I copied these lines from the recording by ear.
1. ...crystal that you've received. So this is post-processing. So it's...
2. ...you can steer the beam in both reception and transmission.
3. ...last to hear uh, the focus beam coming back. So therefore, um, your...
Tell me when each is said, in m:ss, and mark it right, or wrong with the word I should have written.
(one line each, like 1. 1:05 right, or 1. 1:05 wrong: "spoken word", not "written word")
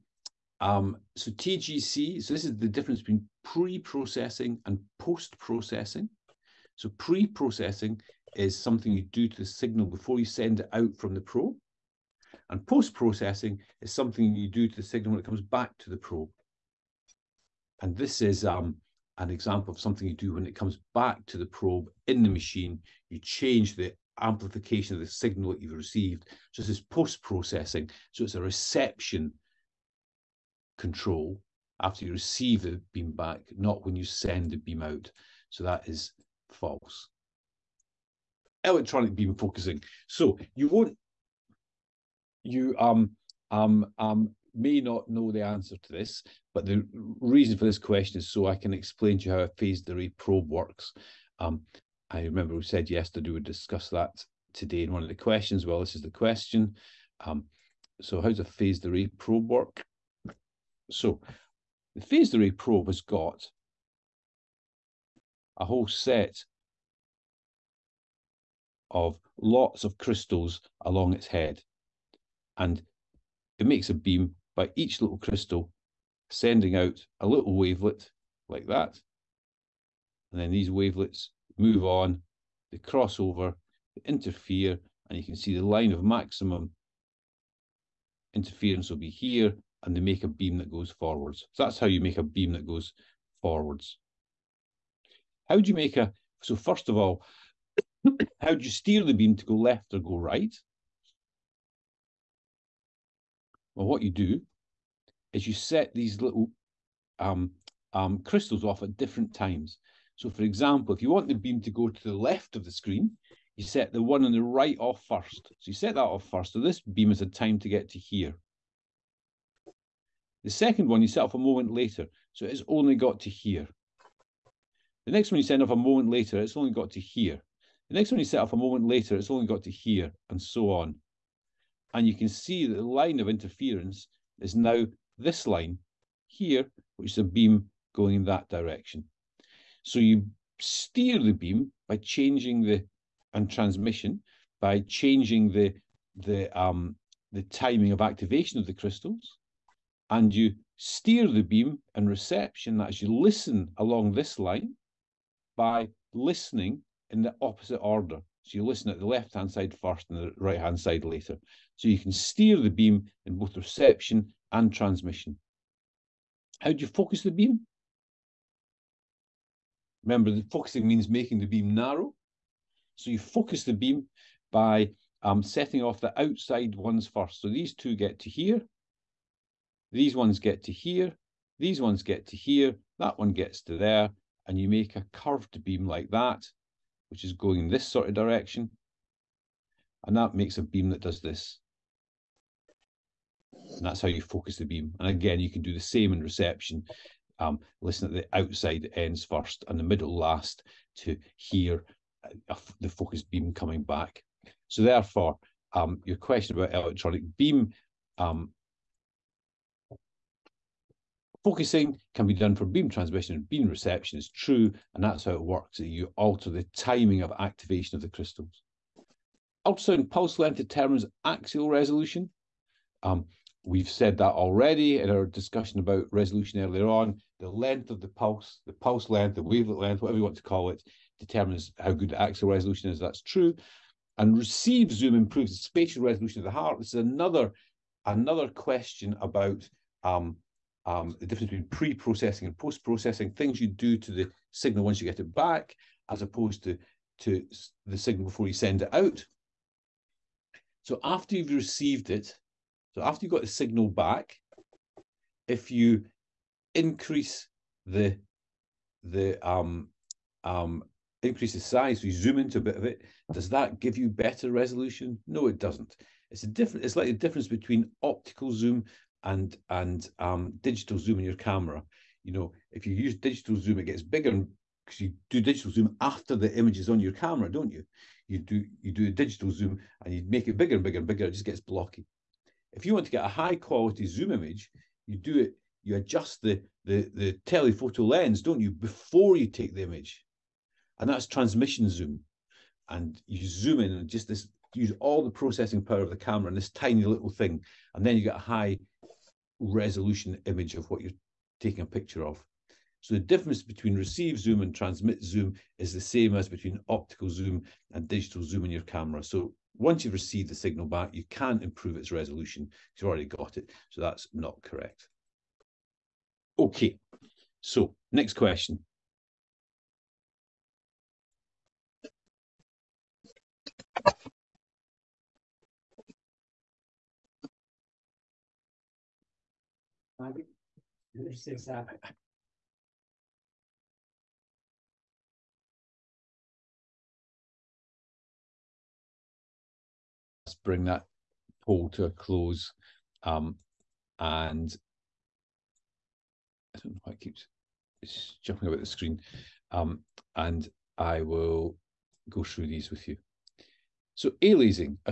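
1. 0:25 wrong: "signal", not "crystal"
2. 2:41 right
3. 3:20 right.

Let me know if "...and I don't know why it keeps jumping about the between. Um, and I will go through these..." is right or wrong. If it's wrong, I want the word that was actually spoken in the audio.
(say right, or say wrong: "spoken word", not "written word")
wrong: "screen", not "between".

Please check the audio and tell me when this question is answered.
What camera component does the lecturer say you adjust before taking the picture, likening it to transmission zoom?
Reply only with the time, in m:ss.
4:47.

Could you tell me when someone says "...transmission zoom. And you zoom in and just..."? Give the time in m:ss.
4:51.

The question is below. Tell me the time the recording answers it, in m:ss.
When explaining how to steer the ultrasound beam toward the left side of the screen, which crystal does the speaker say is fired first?
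1:53.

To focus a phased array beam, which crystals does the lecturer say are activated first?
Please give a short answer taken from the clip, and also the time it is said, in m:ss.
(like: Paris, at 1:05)
The outside ones, at 2:56.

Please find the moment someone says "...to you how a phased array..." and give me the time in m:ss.
0:49.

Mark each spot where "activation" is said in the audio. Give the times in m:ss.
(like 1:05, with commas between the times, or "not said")
2:28, 3:37.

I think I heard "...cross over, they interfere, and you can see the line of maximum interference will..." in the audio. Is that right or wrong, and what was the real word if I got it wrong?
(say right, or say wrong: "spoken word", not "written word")
right.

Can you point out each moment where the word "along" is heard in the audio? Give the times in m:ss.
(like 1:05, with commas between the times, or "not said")
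1:10, 2:33.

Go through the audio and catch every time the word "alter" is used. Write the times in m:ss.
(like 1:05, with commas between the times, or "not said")
3:36.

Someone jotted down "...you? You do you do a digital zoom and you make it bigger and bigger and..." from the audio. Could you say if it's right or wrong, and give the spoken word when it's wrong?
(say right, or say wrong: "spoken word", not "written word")
right.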